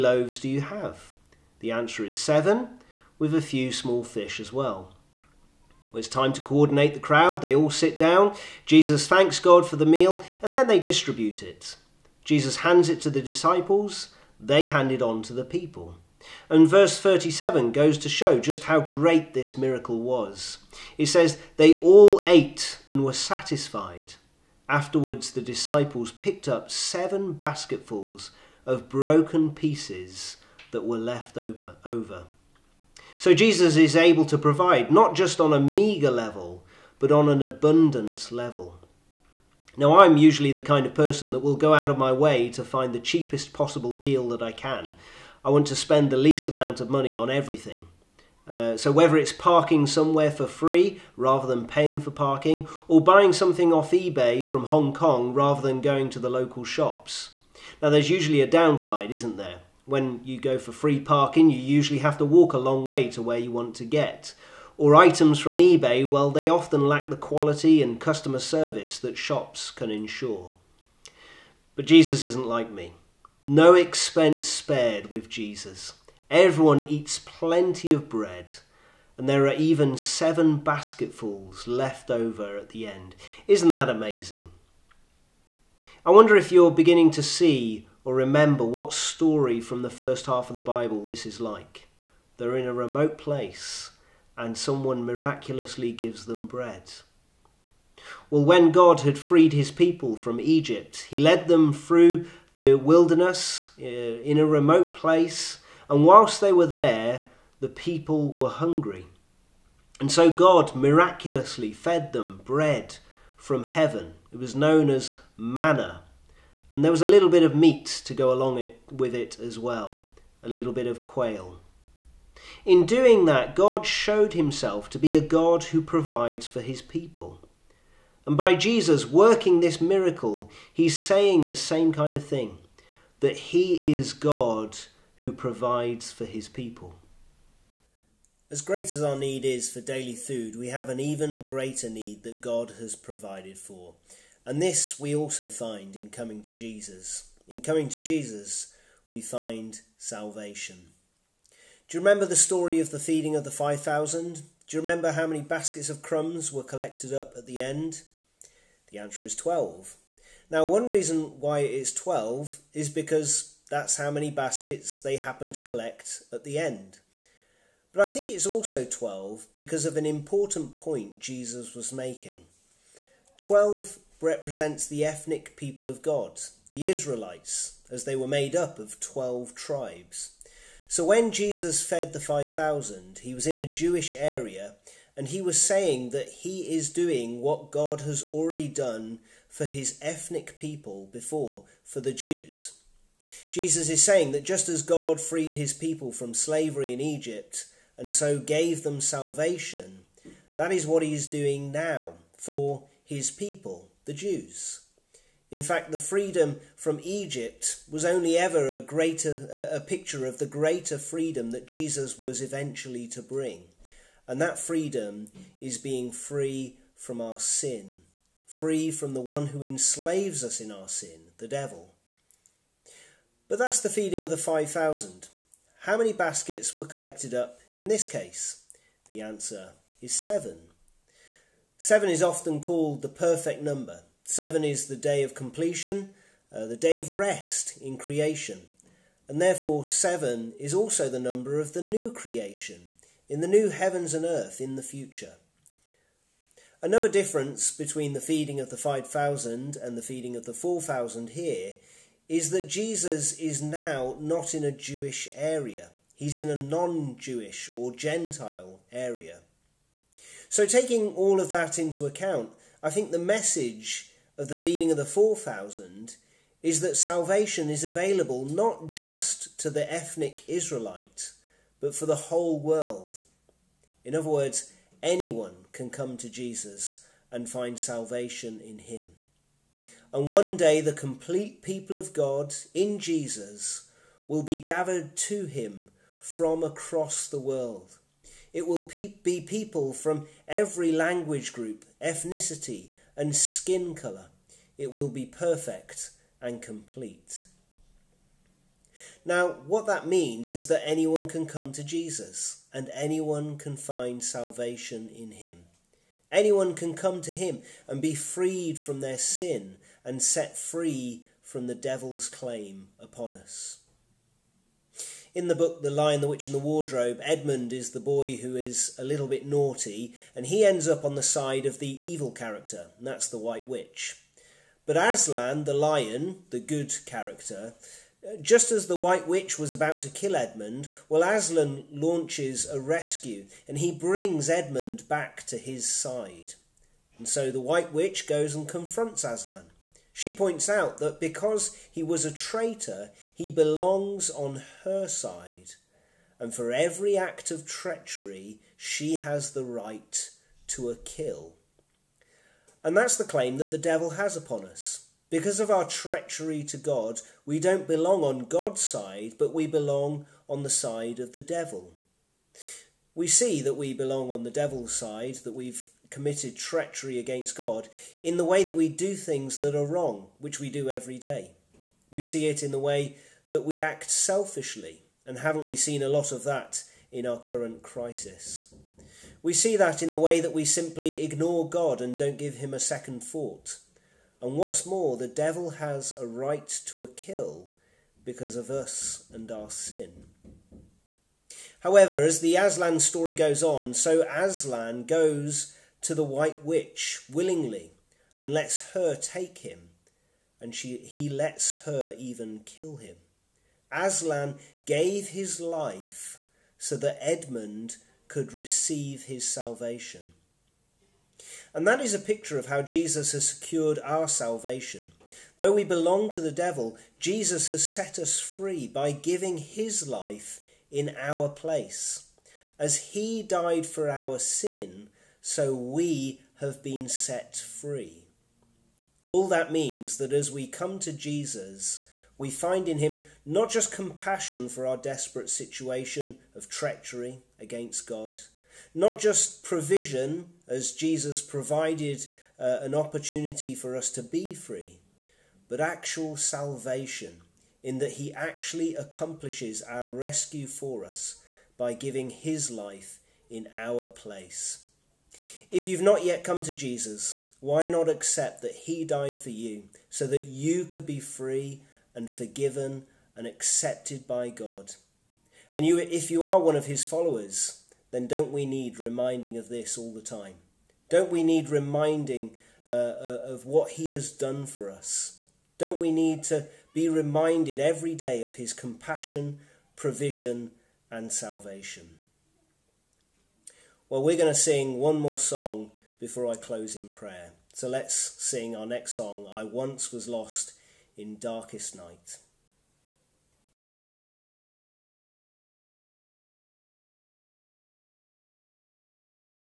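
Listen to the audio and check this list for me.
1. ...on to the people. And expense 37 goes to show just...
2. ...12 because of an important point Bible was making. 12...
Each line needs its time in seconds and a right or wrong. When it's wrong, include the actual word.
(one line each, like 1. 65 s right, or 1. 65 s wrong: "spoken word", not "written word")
1. 15 s wrong: "verse", not "expense"
2. 168 s wrong: "Jesus", not "Bible".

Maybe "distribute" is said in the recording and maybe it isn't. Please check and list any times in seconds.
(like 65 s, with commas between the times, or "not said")
10 s.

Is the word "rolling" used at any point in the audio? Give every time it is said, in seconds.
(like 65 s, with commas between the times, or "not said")
not said.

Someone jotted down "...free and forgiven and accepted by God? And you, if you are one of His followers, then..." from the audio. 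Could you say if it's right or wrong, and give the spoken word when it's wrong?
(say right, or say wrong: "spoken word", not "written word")
right.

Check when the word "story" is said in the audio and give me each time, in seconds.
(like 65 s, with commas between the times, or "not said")
88 s, 152 s, 392 s.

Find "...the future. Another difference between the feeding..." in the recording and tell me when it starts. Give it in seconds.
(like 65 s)
244 s.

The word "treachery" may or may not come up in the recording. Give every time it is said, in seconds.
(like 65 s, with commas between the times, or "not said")
347 s, 355 s, 366 s, 436 s.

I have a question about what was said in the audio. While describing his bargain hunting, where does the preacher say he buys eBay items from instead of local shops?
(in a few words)
Hong Kong.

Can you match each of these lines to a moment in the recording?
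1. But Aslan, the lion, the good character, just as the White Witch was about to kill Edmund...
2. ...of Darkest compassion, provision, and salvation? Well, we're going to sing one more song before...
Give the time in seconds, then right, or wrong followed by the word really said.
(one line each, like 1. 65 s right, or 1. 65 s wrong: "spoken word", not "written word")
1. 324 s right
2. 478 s wrong: "His", not "Darkest".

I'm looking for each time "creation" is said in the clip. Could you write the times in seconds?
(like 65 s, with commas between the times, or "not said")
237 s, 242 s.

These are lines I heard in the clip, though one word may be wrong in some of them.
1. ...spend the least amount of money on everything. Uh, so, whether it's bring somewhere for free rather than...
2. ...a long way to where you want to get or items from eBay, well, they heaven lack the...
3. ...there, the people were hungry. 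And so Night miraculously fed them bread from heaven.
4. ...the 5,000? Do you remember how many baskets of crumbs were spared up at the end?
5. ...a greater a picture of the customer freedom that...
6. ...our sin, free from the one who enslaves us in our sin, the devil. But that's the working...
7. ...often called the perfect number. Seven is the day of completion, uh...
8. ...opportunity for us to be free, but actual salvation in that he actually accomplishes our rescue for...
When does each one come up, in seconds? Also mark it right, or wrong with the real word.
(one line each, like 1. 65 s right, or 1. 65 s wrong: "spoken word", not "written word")
1. 45 s wrong: "parking", not "bring"
2. 62 s wrong: "often", not "heaven"
3. 106 s wrong: "God", not "Night"
4. 153 s wrong: "collected", not "spared"
5. 208 s wrong: "greater", not "customer"
6. 217 s wrong: "feeding", not "working"
7. 232 s right
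8. 442 s right.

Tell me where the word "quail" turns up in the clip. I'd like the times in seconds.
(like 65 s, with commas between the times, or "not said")
121 s.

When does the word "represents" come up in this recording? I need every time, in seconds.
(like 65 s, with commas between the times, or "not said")
174 s.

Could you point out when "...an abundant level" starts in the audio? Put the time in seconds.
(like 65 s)
37 s.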